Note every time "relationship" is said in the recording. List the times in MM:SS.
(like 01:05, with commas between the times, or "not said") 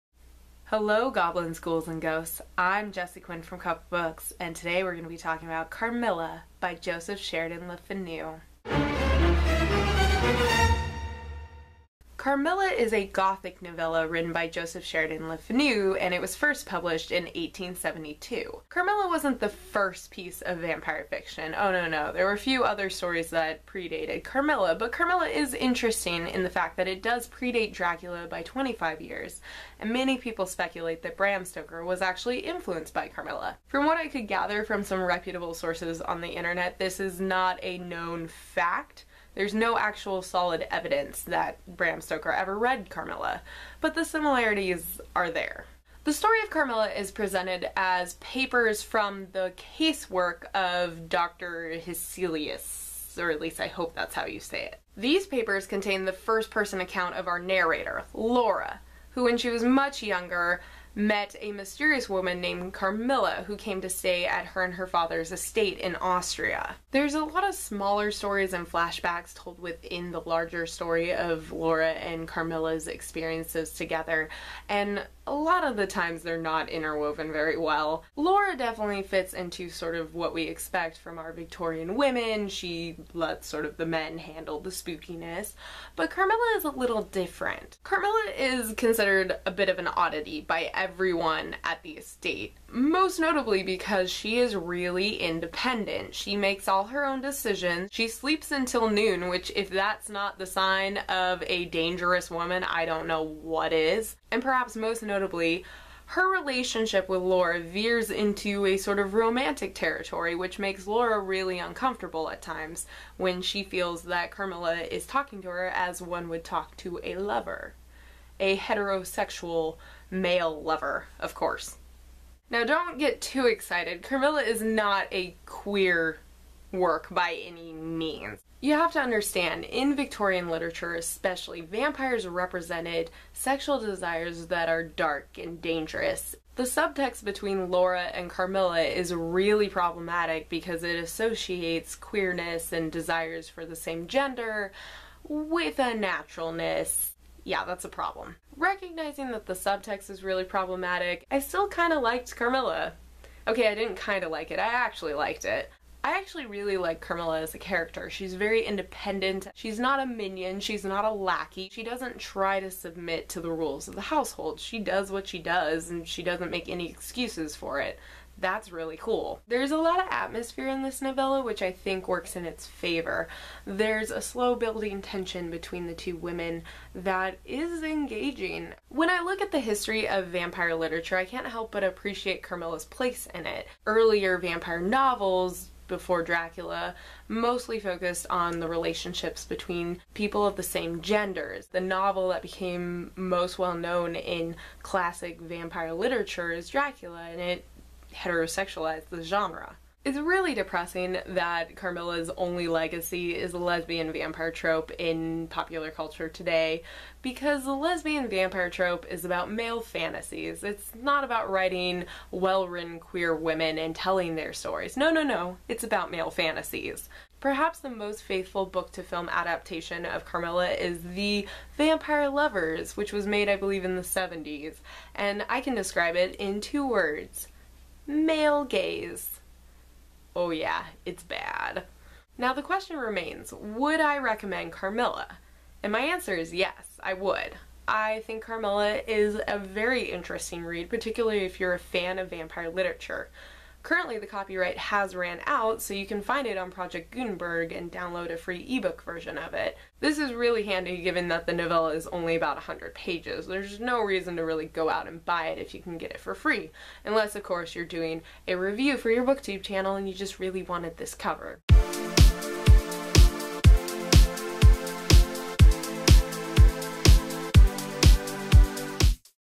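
01:46, 03:08.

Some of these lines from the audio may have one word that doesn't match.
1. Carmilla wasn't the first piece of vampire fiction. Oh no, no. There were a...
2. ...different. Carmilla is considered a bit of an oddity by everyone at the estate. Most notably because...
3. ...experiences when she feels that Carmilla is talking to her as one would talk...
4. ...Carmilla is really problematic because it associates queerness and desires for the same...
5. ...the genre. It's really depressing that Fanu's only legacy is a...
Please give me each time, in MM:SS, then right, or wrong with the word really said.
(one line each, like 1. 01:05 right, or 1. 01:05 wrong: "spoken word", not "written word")
1. 00:18 right
2. 01:27 right
3. 01:52 wrong: "times", not "experiences"
4. 02:18 right
5. 03:19 wrong: "Carmilla", not "Fanu".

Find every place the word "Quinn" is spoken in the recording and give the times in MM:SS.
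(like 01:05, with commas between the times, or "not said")
00:03.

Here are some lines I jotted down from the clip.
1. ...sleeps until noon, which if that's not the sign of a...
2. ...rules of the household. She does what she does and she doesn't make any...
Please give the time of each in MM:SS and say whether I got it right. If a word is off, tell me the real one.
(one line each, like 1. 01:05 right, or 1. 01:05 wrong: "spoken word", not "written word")
1. 01:38 right
2. 02:43 right.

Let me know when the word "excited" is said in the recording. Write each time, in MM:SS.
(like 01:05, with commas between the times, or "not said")
02:03.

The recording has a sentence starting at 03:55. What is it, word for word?
And my answer is yes, I would.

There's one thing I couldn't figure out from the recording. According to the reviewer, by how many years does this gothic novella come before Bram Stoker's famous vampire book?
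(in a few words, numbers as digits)
25.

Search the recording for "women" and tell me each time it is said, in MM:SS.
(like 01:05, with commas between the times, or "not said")
01:21, 02:56, 03:33.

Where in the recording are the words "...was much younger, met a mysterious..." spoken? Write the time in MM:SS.
00:59.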